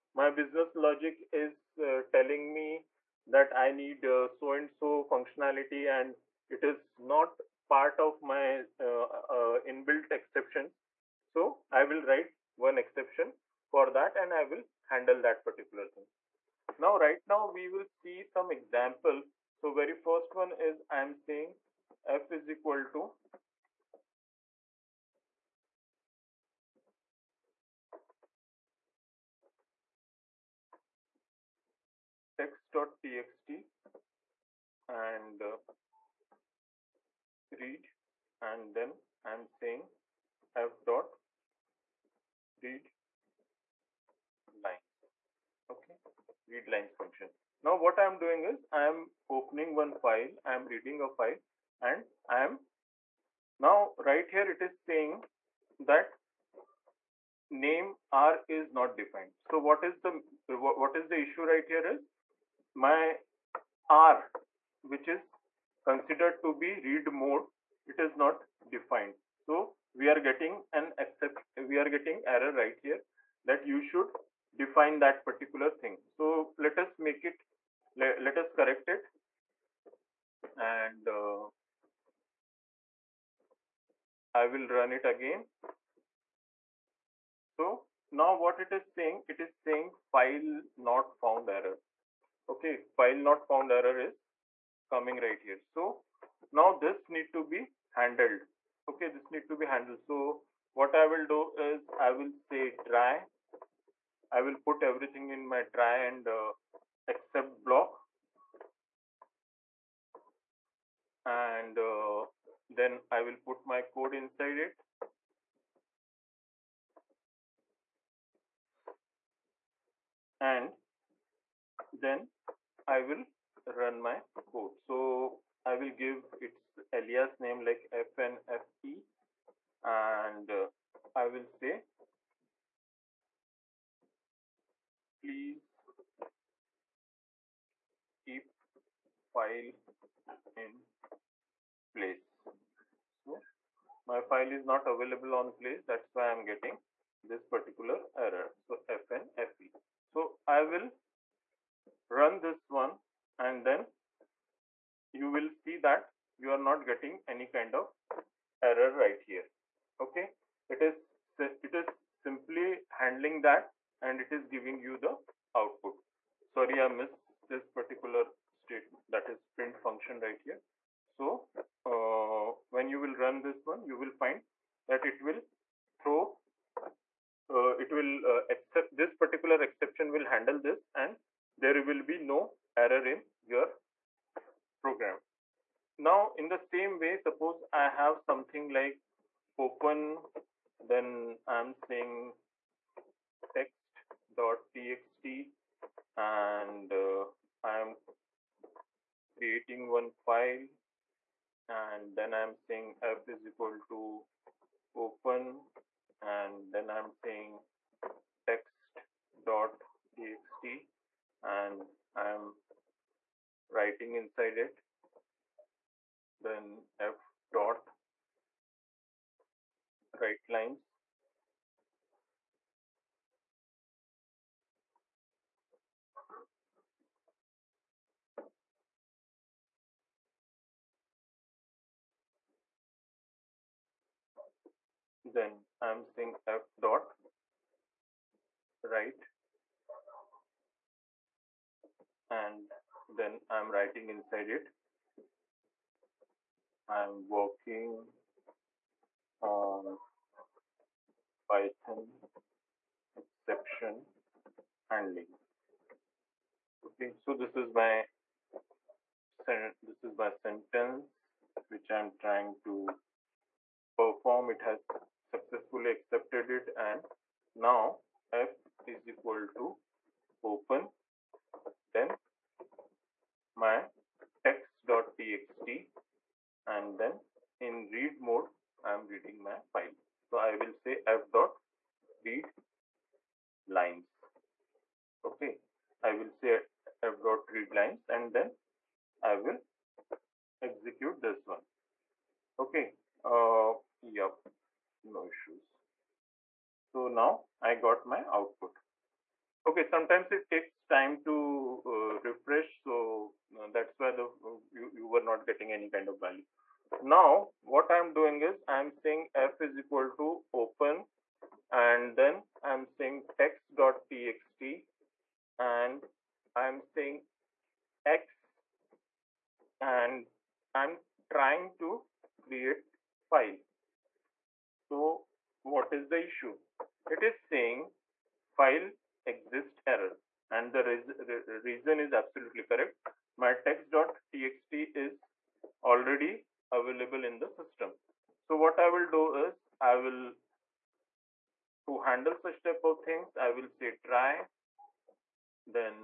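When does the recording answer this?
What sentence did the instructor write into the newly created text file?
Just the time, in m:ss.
4:06.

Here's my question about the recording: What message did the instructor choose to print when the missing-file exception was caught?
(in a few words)
Please keep file in place.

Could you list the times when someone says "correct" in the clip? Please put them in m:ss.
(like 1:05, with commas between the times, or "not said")
1:18, 5:32.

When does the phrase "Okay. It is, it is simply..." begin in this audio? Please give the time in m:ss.
2:40.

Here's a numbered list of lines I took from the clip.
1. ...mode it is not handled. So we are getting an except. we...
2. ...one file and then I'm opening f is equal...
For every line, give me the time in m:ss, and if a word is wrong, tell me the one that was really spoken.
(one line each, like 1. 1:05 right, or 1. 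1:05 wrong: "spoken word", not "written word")
1. 1:07 wrong: "defined", not "handled"
2. 3:19 wrong: "saying", not "opening".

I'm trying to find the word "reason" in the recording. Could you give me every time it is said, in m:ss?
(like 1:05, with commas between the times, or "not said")
5:31.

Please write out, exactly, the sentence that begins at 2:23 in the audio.
So my file is not available on place.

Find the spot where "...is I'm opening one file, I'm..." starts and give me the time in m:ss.
0:48.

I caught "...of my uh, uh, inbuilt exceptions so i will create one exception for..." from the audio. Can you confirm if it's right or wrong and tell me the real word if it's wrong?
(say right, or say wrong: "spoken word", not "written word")
wrong: "write", not "create".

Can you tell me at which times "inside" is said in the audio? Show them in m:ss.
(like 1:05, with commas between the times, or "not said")
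1:54, 3:34, 4:04.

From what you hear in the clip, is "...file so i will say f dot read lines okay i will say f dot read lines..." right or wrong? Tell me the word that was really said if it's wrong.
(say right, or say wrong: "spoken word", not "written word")
right.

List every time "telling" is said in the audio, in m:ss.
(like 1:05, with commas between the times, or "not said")
0:02.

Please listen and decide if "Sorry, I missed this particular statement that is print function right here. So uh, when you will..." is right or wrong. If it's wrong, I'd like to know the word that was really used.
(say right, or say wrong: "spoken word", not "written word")
right.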